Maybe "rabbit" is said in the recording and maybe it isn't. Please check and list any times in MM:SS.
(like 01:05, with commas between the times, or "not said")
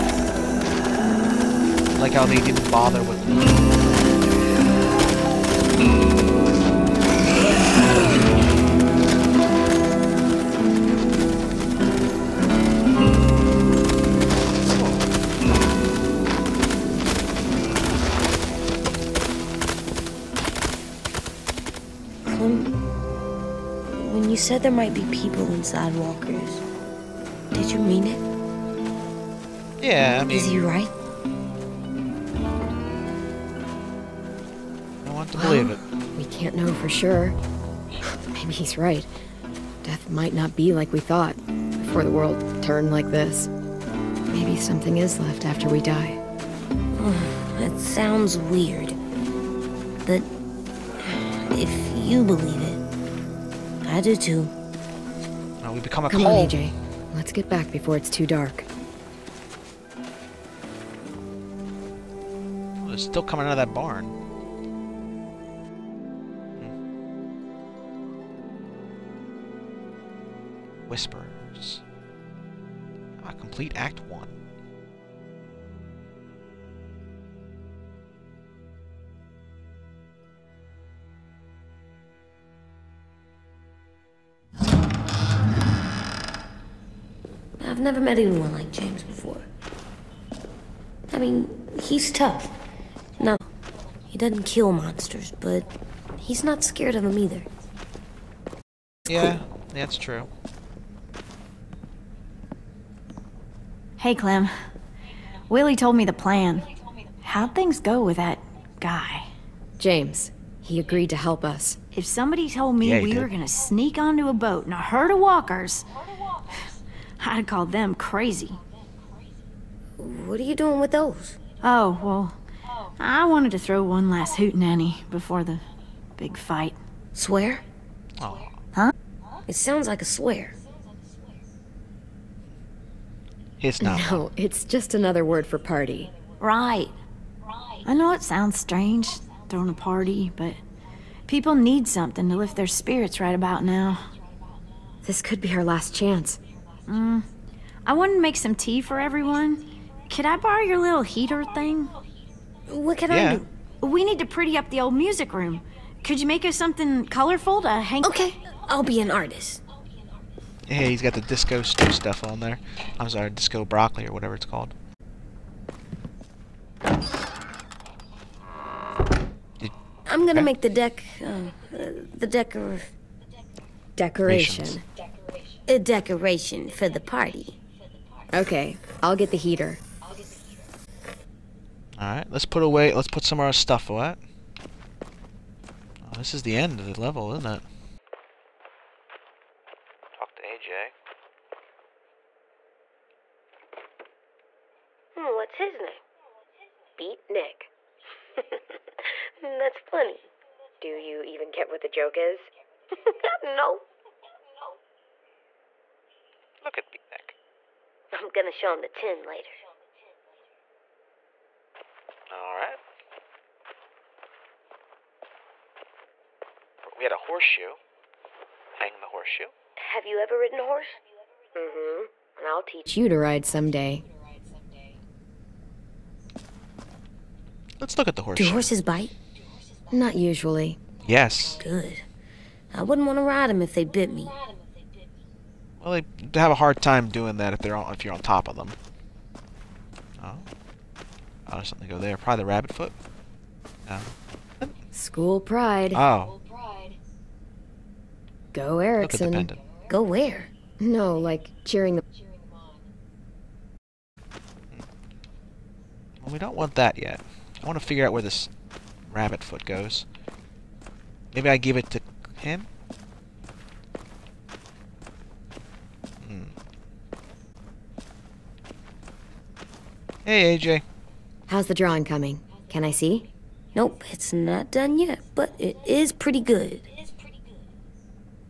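04:02, 04:19.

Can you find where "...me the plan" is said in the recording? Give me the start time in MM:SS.
01:45.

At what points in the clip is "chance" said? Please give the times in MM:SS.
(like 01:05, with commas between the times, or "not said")
02:25.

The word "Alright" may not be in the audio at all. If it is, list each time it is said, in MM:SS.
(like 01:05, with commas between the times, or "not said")
03:01, 03:32.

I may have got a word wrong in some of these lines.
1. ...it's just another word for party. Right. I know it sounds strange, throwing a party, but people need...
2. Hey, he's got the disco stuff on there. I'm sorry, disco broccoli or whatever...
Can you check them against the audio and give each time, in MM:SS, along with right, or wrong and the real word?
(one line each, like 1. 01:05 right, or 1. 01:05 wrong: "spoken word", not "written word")
1. 02:14 right
2. 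02:40 right.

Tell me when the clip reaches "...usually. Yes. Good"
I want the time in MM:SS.
03:50.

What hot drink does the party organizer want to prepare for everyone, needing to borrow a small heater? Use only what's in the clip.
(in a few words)
tea.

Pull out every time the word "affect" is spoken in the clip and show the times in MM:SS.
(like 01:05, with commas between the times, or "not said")
not said.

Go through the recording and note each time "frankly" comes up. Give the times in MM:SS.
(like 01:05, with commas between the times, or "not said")
not said.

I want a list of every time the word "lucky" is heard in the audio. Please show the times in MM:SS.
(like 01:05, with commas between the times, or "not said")
not said.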